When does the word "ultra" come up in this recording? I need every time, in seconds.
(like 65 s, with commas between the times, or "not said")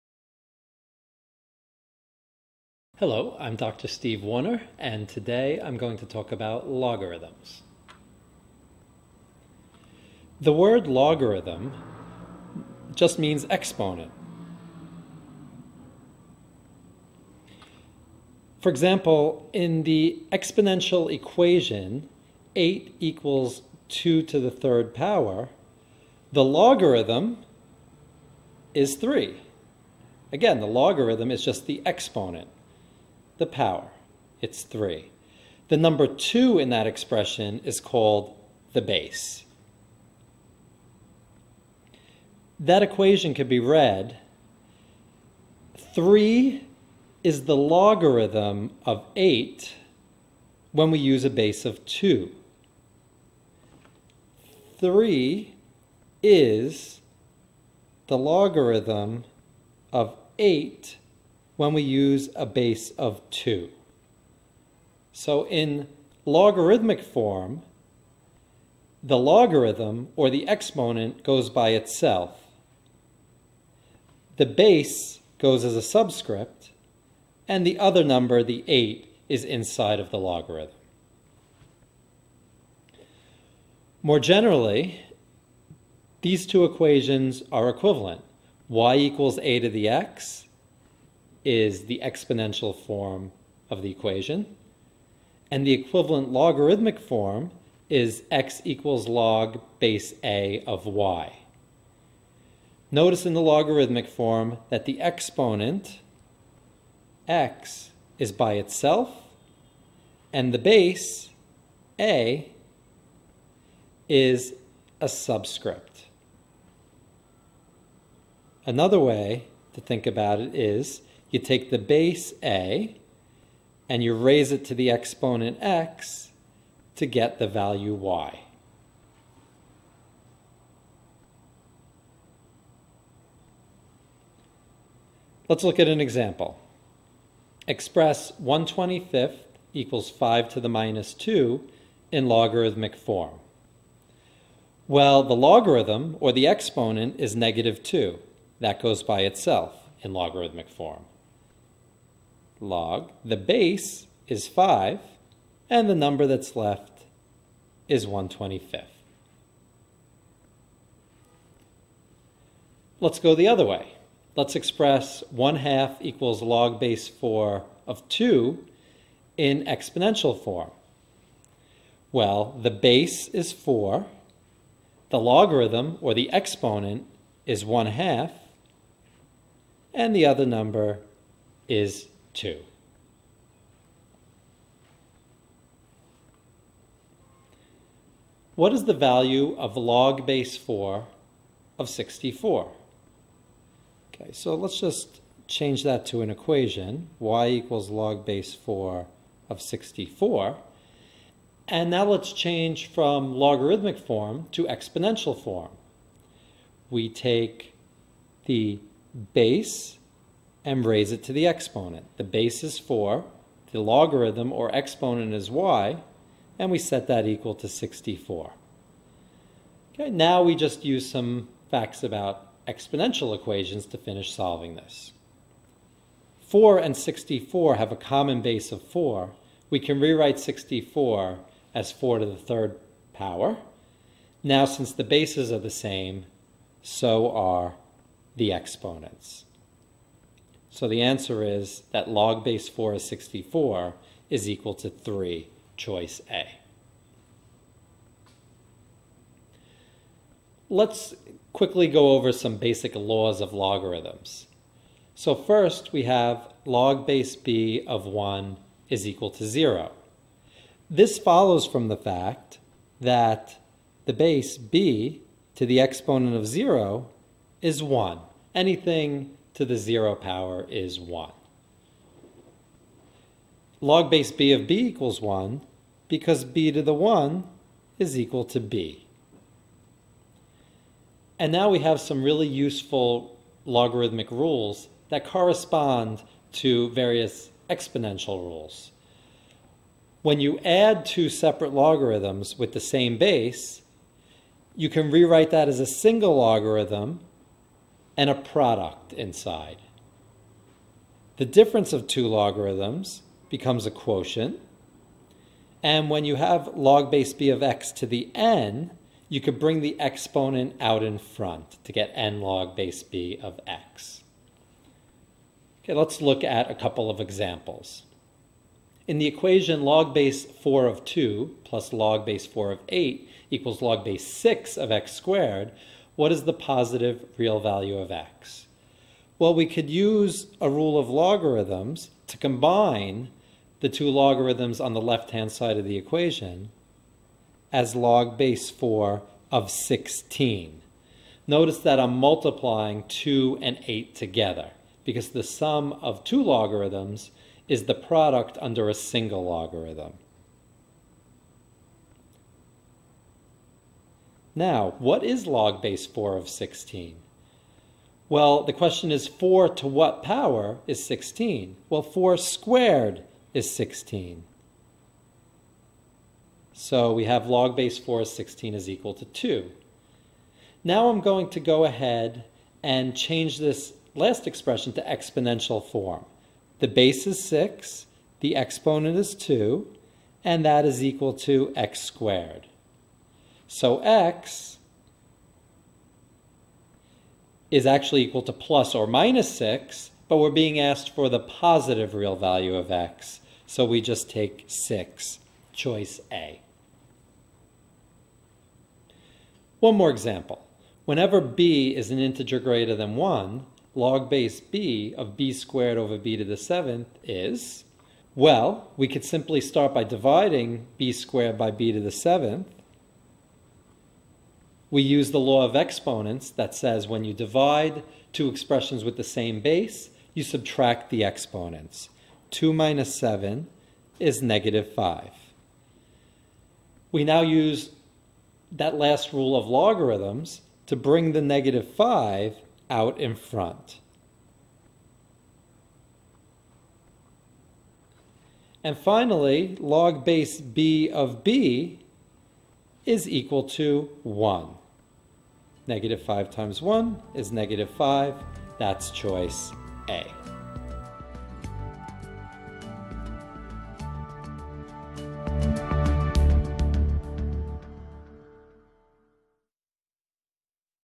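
not said.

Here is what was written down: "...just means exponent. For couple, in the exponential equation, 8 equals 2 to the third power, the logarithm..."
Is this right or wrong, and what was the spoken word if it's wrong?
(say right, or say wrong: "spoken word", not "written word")
wrong: "example", not "couple".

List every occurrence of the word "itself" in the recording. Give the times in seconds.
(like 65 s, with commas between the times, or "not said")
71 s, 108 s, 149 s.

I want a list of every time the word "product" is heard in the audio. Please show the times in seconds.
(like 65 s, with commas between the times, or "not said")
298 s, 347 s.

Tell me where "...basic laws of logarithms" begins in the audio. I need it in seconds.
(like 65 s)
252 s.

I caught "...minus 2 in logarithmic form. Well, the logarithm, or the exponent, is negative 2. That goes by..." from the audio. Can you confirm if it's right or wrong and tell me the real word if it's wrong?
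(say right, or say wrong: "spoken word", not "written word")
right.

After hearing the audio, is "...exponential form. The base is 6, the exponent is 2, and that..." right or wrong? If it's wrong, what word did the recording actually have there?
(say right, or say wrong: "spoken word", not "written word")
right.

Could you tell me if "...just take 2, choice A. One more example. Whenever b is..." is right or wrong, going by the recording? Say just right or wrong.
wrong.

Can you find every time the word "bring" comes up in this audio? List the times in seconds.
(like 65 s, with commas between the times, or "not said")
309 s, 430 s.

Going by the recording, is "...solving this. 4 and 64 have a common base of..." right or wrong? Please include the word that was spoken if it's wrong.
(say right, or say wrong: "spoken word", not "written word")
right.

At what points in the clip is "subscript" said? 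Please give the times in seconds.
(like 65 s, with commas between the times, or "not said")
75 s, 115 s.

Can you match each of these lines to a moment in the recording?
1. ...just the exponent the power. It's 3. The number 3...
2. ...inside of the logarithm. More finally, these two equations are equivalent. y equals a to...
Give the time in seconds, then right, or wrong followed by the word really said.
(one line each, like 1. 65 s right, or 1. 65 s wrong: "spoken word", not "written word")
1. 31 s wrong: "2", not "3"
2. 79 s wrong: "generally", not "finally".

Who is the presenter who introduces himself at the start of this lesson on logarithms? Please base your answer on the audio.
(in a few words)
Dr. Steve Warner.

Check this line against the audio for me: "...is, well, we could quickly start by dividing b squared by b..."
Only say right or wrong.
wrong.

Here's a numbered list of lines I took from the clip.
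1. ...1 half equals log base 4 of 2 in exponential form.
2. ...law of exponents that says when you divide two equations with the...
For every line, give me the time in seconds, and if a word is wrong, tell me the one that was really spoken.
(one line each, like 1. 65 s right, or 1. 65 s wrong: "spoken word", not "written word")
1. 165 s right
2. 415 s wrong: "expressions", not "equations".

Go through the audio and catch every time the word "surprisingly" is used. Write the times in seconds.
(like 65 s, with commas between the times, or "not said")
not said.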